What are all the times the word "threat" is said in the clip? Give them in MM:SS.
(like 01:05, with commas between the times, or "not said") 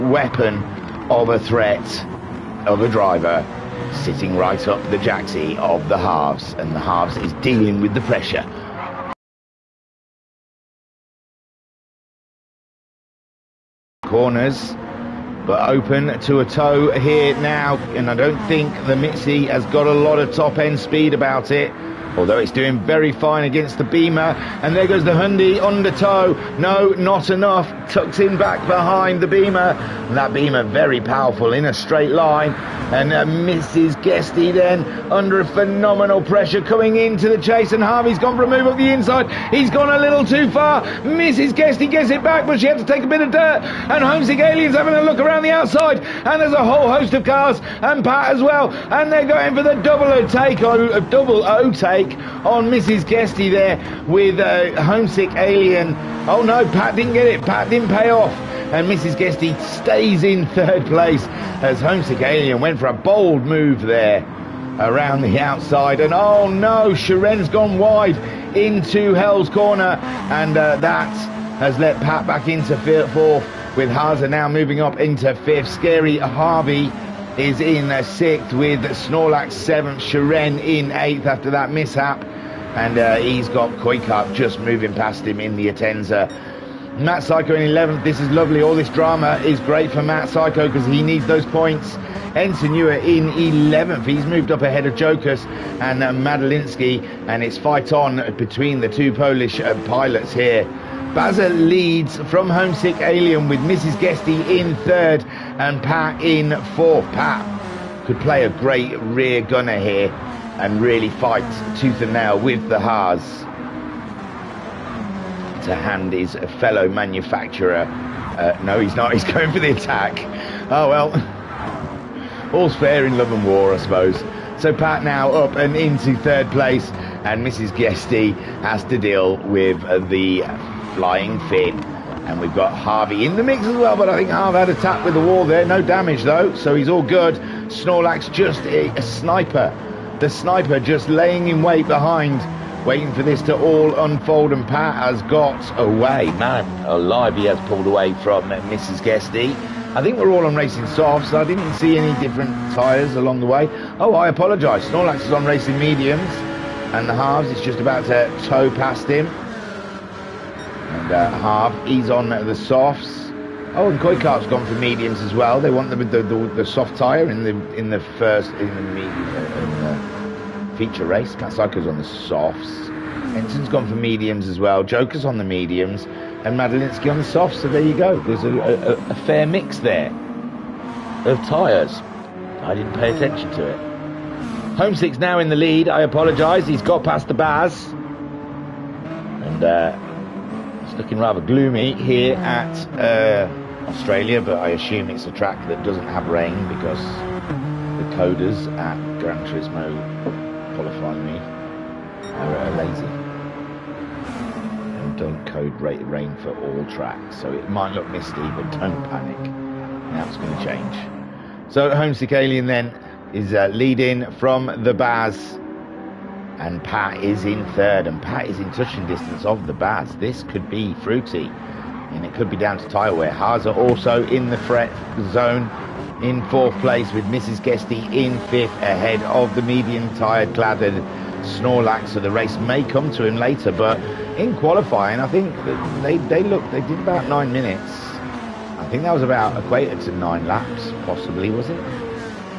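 00:01, 03:44.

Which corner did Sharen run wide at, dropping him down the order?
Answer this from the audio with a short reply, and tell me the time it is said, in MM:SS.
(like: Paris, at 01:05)
Hell's Corner, at 01:09.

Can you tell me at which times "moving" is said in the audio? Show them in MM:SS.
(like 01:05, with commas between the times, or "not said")
01:14, 01:24.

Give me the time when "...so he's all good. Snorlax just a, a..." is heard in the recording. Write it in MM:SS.
02:16.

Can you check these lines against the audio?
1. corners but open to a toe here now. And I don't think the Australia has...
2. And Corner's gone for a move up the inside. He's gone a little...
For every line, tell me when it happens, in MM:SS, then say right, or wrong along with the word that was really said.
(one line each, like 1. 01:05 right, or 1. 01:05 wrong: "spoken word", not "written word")
1. 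00:14 wrong: "Mitzi", not "Australia"
2. 00:37 wrong: "Harvey", not "Corner".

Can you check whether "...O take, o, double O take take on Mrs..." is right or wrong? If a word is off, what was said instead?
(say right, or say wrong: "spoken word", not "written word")
right.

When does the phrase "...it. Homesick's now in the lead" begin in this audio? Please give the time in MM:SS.
03:03.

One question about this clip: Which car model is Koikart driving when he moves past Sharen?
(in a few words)
Atenza.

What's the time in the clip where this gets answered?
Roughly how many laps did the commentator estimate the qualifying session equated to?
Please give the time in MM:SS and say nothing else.
04:00.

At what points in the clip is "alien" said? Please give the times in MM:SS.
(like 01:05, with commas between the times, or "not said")
00:44, 00:55, 01:02, 01:43, 03:32.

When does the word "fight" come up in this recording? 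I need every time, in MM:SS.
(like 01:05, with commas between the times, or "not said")
01:37, 01:51.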